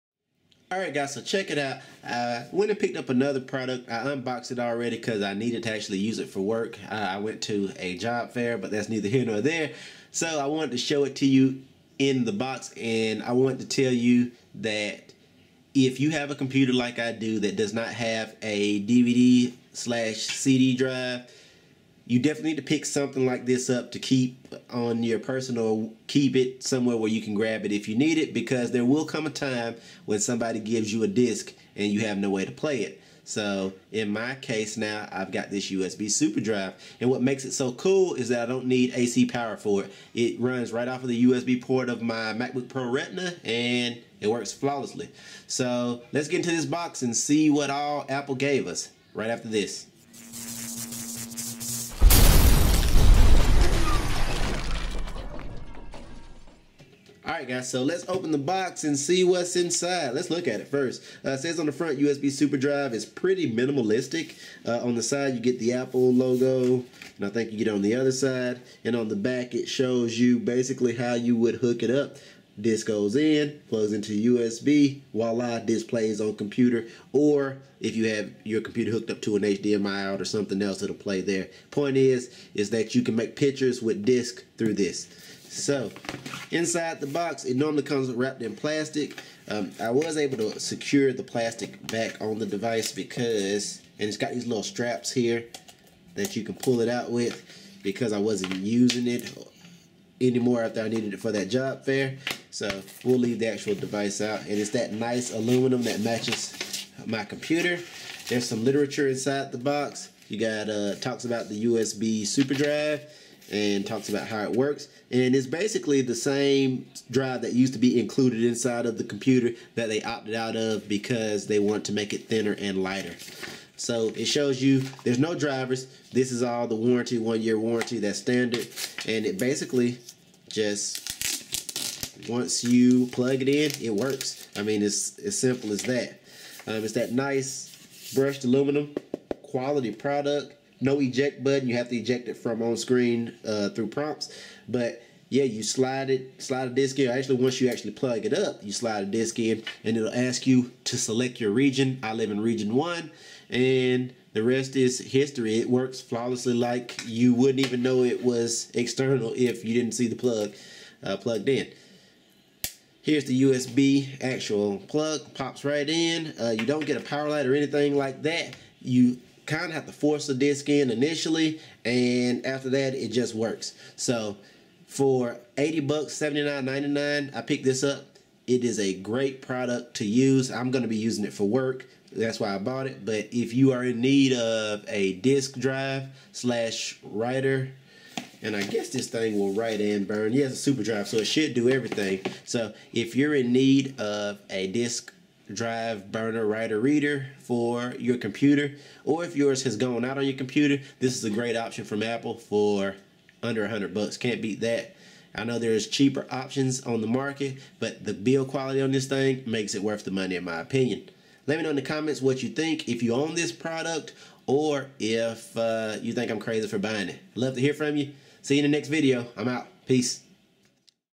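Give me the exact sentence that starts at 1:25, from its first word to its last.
So, inside the box, it normally comes wrapped in plastic.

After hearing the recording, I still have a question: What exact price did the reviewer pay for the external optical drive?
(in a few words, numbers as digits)
$79.99.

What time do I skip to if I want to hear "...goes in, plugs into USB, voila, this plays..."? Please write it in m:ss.
1:12.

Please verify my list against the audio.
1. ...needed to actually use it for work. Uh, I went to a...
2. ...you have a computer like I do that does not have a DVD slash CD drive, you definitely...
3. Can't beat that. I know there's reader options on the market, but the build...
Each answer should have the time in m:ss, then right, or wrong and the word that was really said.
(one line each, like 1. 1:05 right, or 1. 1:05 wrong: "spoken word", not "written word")
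1. 0:05 right
2. 0:15 right
3. 3:24 wrong: "cheaper", not "reader".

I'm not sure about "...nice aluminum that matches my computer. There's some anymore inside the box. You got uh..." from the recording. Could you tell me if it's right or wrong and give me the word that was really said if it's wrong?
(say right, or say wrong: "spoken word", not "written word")
wrong: "literature", not "anymore".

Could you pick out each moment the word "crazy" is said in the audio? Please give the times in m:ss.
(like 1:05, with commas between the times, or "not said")
3:36.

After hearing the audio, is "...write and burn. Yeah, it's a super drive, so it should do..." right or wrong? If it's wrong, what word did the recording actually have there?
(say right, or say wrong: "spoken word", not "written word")
right.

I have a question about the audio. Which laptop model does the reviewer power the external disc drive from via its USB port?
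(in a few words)
MacBook Pro Retina.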